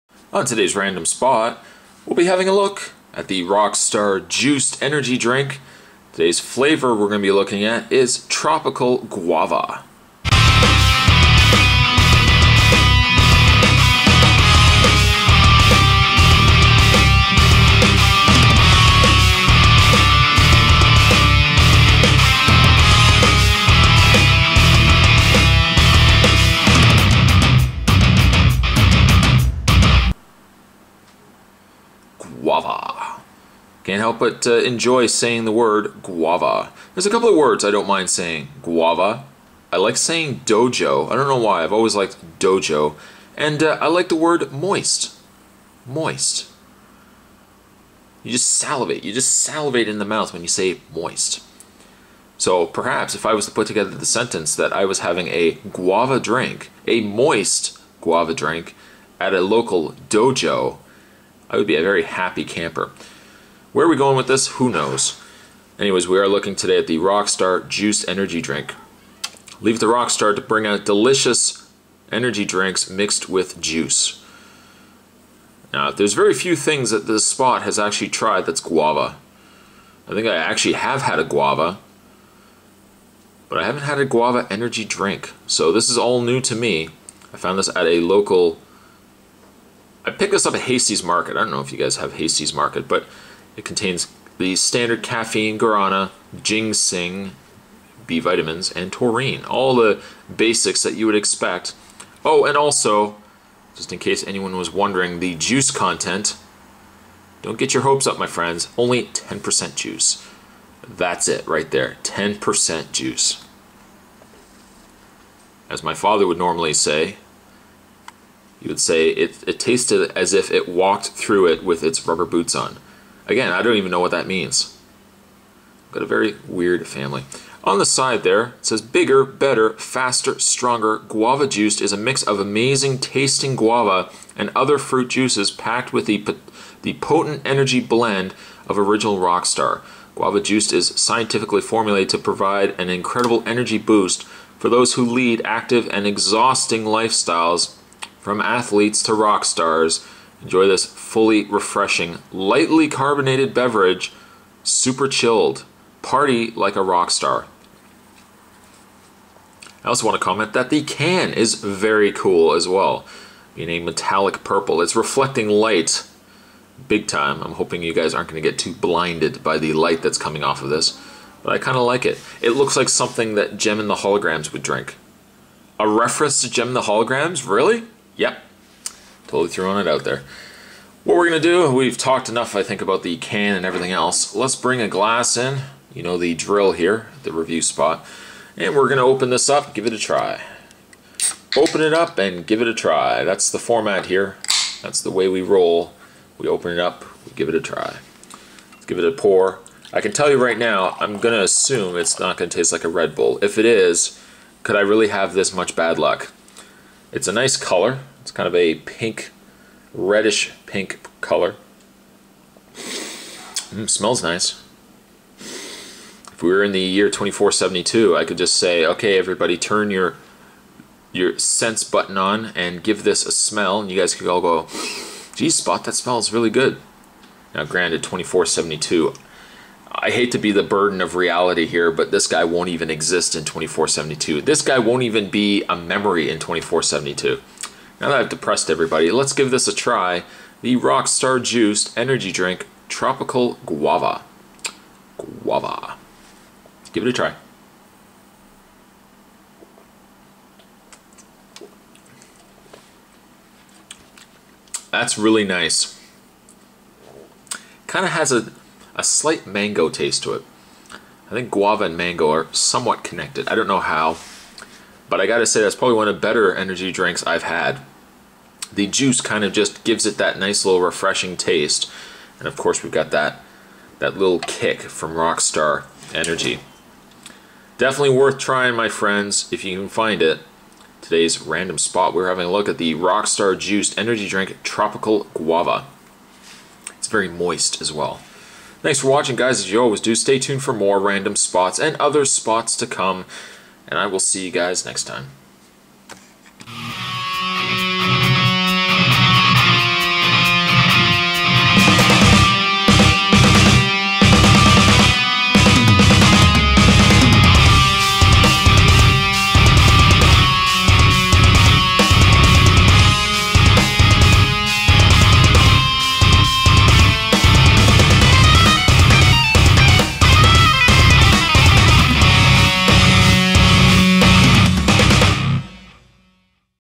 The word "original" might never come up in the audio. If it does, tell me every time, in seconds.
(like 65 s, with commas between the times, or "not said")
138 s.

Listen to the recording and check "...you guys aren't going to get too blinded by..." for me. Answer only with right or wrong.
right.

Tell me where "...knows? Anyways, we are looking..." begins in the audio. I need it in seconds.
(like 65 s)
64 s.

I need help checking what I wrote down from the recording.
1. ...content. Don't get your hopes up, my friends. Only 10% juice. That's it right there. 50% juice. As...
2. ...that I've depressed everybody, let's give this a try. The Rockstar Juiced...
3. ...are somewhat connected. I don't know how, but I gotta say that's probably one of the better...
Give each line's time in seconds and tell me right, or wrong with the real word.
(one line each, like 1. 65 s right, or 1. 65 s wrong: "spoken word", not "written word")
1. 105 s wrong: "10", not "50"
2. 238 s right
3. 262 s right.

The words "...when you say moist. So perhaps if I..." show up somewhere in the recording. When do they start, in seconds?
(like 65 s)
50 s.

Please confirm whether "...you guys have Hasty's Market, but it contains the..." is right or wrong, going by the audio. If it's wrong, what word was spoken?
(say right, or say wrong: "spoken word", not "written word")
right.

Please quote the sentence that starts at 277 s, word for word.
Definitely worth trying, my friends, if you can find it.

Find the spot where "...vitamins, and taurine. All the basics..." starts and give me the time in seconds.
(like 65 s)
98 s.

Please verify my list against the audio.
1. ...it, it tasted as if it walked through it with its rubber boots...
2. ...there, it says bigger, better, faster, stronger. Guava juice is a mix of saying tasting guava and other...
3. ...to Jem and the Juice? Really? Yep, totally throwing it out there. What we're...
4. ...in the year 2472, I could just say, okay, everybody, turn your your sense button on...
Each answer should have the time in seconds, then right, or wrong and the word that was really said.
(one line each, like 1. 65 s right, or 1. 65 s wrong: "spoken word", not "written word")
1. 119 s right
2. 128 s wrong: "amazing", not "saying"
3. 176 s wrong: "Holograms", not "Juice"
4. 216 s right.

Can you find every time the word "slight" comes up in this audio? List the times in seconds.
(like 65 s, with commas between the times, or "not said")
259 s.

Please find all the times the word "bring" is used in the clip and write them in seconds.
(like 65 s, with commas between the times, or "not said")
70 s, 184 s.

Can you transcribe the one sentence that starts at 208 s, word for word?
It's kind of a pink, reddish pink color.